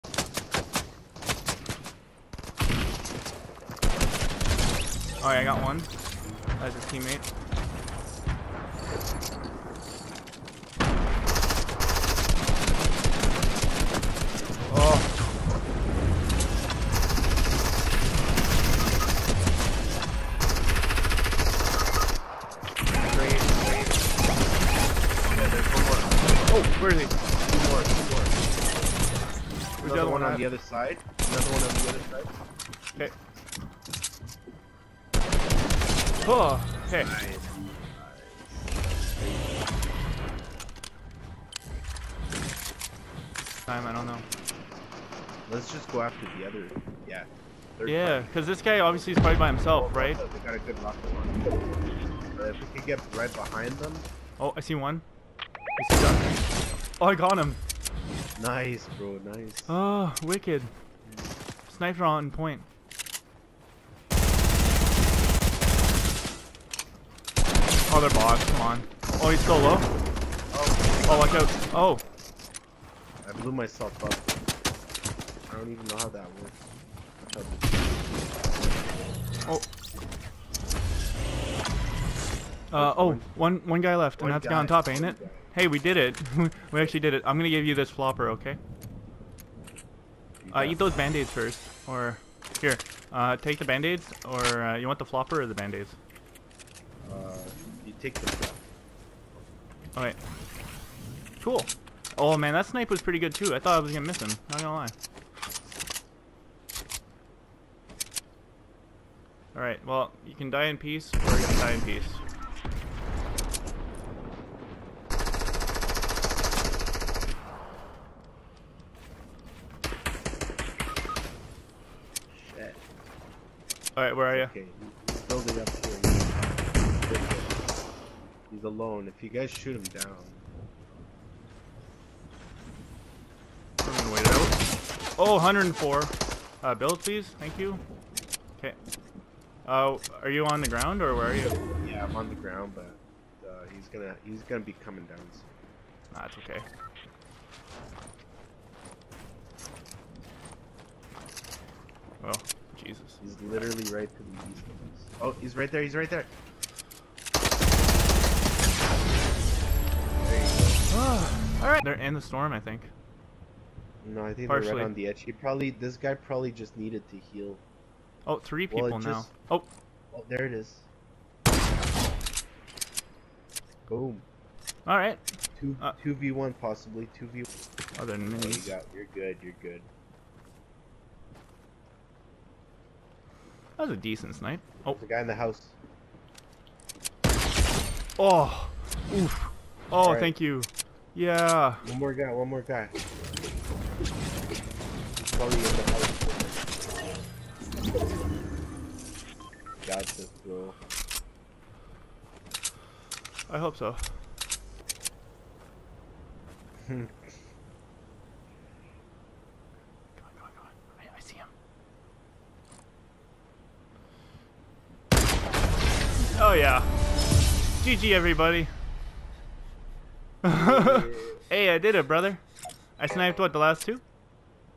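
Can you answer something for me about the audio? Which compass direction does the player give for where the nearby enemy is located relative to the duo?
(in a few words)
East.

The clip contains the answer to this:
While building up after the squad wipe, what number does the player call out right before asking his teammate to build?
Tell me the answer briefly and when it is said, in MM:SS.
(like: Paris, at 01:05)
104, at 02:15.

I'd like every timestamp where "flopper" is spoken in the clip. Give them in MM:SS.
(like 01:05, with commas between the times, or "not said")
01:27, 01:35.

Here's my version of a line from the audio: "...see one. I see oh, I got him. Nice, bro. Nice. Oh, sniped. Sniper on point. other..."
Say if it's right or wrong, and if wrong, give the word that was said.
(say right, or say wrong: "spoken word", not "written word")
wrong: "wicked", not "sniped".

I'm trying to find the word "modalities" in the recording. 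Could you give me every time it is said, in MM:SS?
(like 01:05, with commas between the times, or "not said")
not said.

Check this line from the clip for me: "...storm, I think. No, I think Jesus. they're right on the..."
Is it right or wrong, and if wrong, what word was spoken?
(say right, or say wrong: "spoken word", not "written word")
wrong: "Partially", not "Jesus".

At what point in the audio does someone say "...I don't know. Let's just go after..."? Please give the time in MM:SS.
00:43.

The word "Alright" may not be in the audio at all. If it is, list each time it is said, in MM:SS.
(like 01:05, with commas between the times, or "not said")
00:05, 01:39, 01:49, 02:03, 02:40.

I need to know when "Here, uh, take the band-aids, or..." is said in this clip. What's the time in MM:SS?
01:32.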